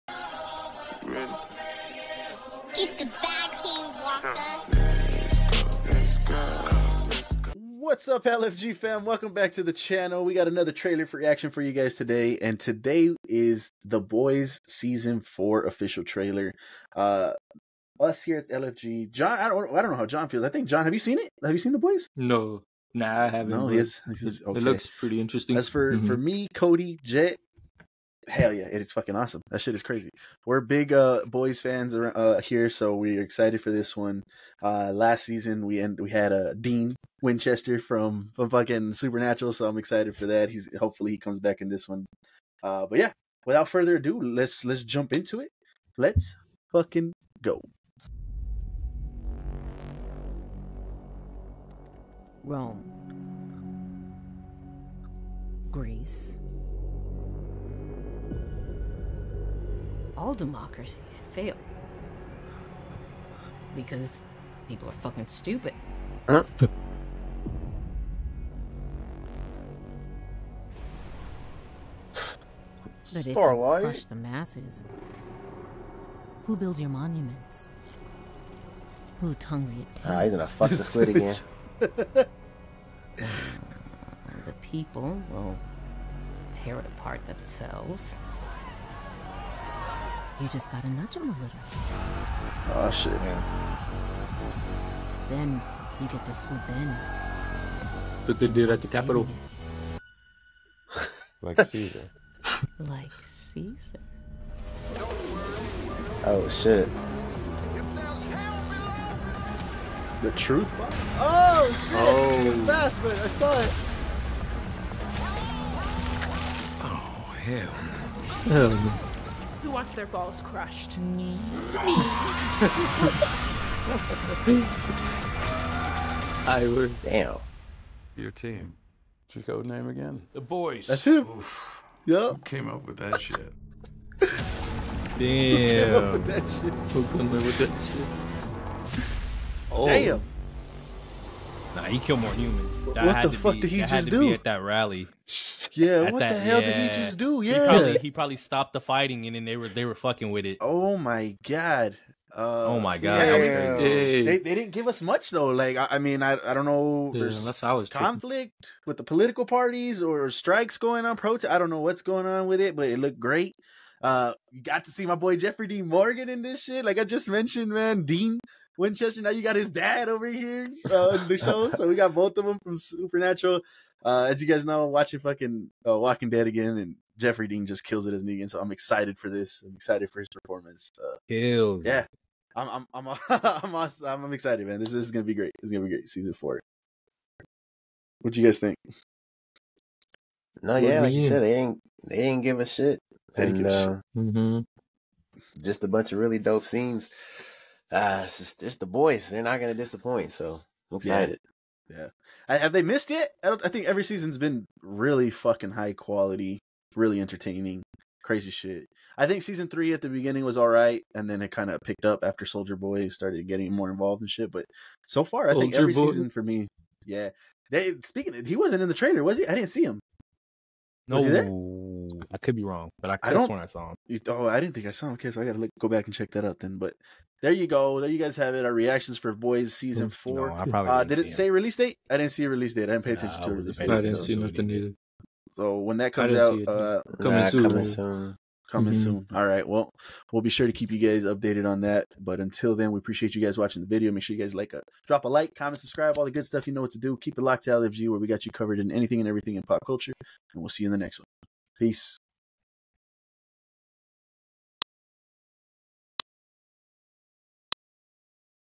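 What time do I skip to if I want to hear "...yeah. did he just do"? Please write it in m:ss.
2:26.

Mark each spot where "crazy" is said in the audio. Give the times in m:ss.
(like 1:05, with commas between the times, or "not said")
0:29, 3:28.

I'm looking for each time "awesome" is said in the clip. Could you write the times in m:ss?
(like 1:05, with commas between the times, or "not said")
0:29, 3:03.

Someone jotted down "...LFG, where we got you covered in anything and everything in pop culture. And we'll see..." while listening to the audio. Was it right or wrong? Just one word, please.
right.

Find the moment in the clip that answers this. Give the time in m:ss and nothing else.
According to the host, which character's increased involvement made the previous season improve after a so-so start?
3:32.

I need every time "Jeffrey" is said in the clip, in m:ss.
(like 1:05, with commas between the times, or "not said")
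2:45, 2:57.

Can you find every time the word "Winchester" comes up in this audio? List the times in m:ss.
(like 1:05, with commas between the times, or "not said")
0:37, 2:48.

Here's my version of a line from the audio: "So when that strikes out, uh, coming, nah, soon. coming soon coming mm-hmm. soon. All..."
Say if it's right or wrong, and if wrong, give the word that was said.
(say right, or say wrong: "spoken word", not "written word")
wrong: "comes", not "strikes".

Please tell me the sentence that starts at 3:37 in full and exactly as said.
They speaking, of, he wasn't in the trailer, was he?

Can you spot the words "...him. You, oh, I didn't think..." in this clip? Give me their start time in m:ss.
3:43.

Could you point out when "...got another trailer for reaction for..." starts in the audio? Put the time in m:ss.
0:10.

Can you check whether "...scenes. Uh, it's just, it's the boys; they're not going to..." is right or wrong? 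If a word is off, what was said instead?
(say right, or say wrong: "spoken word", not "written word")
right.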